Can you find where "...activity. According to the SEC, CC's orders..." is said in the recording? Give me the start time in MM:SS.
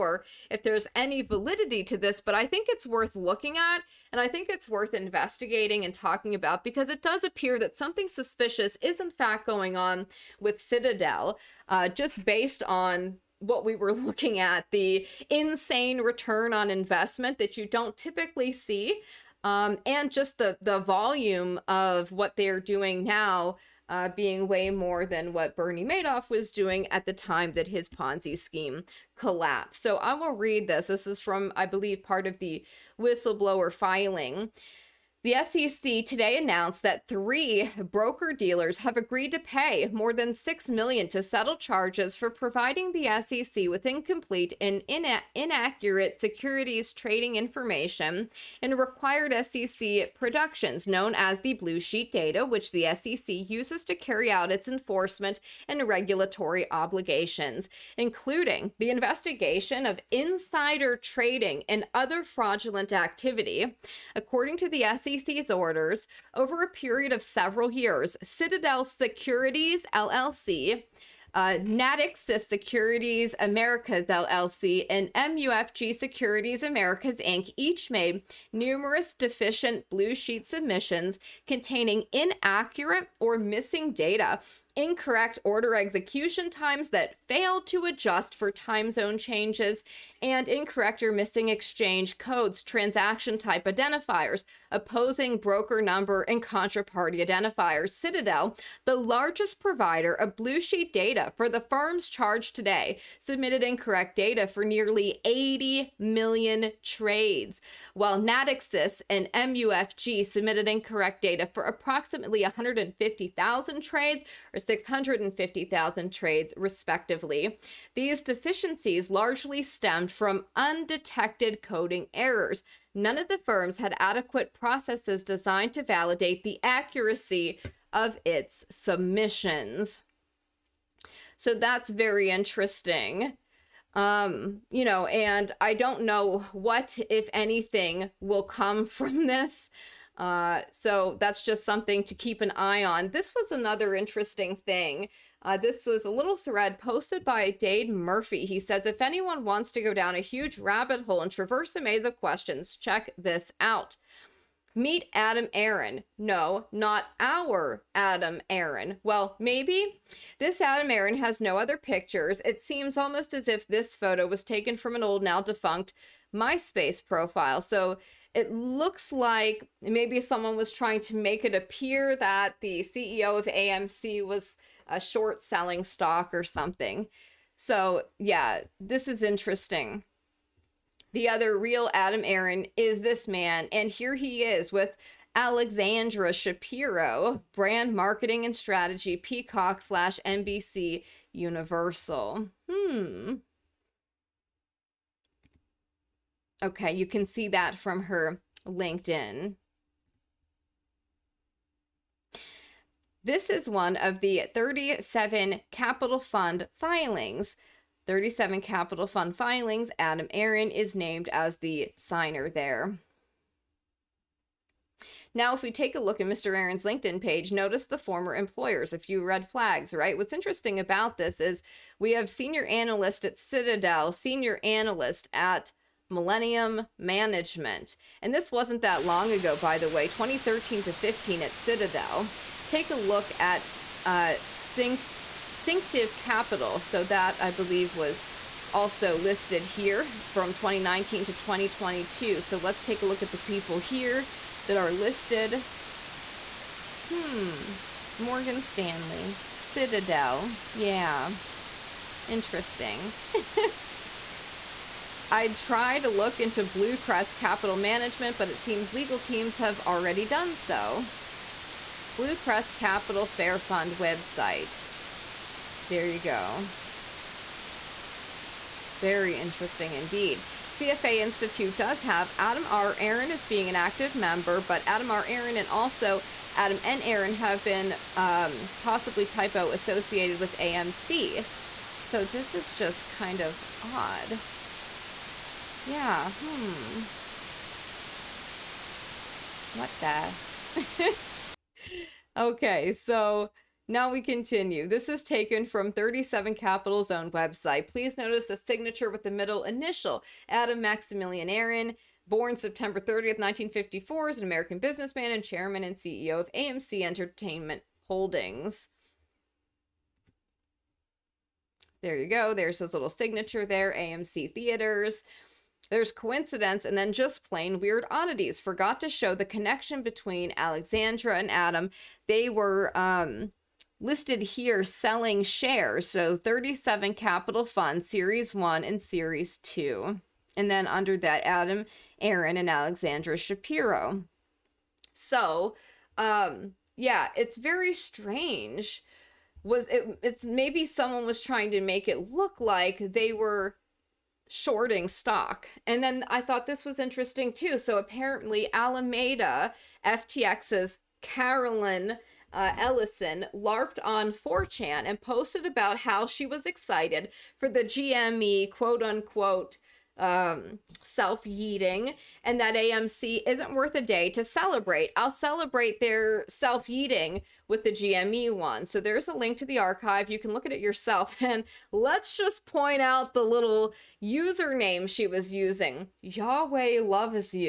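01:02.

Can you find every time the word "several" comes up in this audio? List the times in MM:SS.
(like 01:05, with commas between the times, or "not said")
01:07.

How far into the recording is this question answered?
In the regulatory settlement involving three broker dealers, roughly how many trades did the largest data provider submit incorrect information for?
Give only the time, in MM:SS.
01:44.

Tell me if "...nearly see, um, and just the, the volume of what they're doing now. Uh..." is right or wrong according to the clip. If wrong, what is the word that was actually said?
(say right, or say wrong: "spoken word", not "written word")
wrong: "typically", not "nearly".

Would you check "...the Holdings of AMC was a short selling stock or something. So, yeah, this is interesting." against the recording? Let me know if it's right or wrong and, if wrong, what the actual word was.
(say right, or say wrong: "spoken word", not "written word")
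wrong: "CEO", not "Holdings".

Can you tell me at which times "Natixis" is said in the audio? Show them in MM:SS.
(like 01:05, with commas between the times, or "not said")
01:11, 01:48.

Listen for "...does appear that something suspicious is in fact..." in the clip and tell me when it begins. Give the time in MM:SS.
00:07.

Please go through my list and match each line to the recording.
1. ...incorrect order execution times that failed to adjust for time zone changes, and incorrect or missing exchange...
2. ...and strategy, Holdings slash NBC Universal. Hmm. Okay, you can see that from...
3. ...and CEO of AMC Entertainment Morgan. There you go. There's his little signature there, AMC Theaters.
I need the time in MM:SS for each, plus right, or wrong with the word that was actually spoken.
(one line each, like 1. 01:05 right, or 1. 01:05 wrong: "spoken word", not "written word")
1. 01:24 right
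2. 03:08 wrong: "Peacock", not "Holdings"
3. 05:05 wrong: "Holdings", not "Morgan".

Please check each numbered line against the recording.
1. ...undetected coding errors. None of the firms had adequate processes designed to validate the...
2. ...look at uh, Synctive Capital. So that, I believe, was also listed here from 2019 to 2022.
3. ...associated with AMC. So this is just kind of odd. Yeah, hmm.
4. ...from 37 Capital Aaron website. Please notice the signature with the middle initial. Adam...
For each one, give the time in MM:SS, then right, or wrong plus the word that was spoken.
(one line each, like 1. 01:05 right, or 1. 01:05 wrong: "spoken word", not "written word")
1. 02:00 right
2. 03:52 right
3. 04:39 right
4. 04:55 wrong: "Zone", not "Aaron".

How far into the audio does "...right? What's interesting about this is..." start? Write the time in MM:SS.
03:39.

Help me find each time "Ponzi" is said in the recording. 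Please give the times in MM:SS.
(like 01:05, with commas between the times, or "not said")
00:27.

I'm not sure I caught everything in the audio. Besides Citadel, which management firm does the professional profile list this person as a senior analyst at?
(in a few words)
Millennium Management.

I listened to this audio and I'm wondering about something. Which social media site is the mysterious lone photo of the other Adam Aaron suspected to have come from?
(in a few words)
MySpace.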